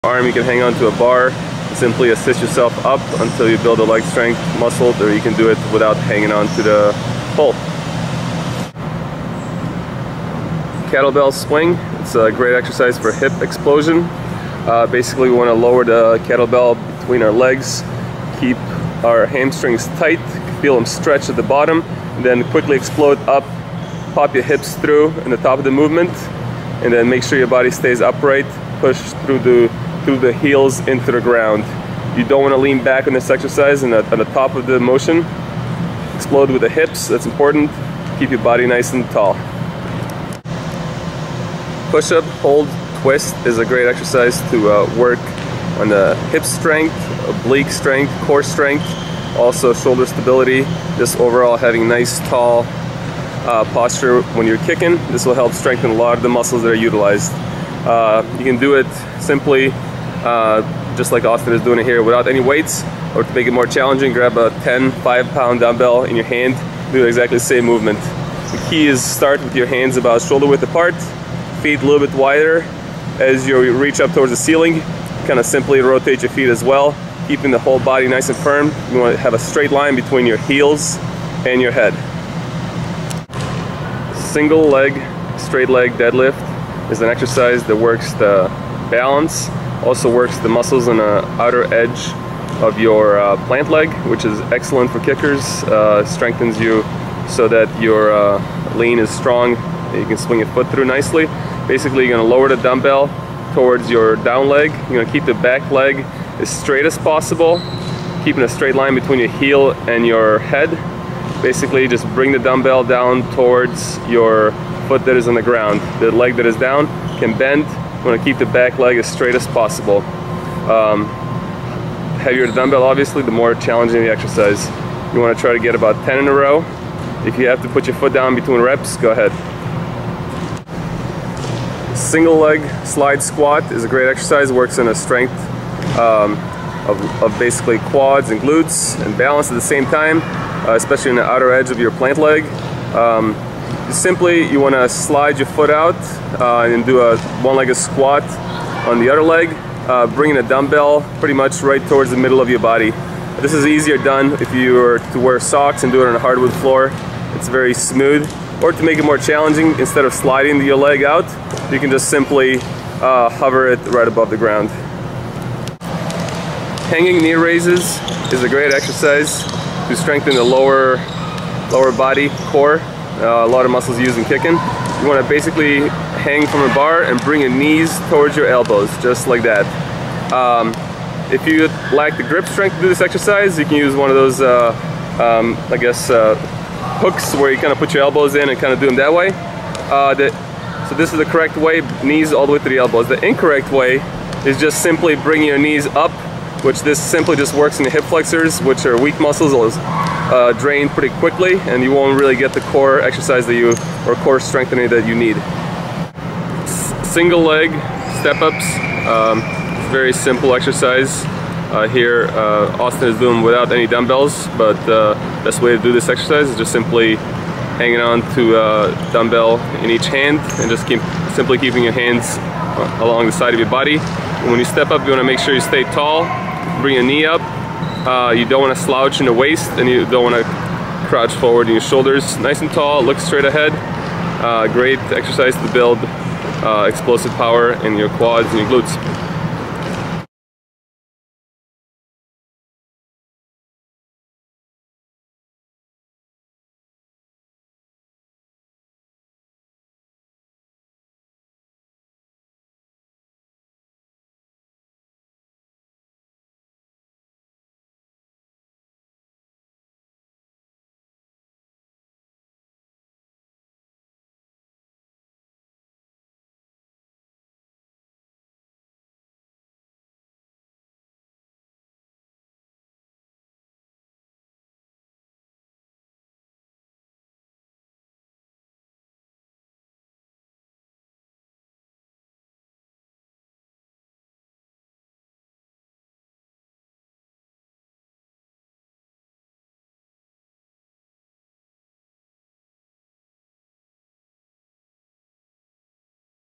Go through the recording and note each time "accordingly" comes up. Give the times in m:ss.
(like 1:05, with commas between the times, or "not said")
not said.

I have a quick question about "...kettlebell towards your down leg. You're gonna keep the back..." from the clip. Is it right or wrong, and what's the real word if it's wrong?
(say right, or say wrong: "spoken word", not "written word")
wrong: "dumbbell", not "kettlebell".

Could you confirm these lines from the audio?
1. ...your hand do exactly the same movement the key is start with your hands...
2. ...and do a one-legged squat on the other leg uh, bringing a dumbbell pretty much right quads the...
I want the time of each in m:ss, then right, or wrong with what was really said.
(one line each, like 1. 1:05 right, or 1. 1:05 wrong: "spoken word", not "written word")
1. 1:06 right
2. 2:26 wrong: "towards", not "quads".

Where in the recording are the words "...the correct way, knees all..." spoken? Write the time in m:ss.
3:11.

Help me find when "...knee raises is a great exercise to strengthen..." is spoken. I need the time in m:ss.
2:47.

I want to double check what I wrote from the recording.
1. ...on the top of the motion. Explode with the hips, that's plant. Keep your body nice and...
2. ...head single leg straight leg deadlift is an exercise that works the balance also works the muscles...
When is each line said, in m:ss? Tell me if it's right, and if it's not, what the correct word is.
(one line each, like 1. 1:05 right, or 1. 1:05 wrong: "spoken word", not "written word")
1. 0:33 wrong: "important", not "plant"
2. 1:21 right.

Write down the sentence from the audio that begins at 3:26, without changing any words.
S single leg step-ups, um, very simple exercise.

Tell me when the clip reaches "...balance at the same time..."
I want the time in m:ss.
2:19.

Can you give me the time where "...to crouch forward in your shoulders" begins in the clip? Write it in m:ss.
3:50.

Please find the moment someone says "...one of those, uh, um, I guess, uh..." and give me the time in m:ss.
3:03.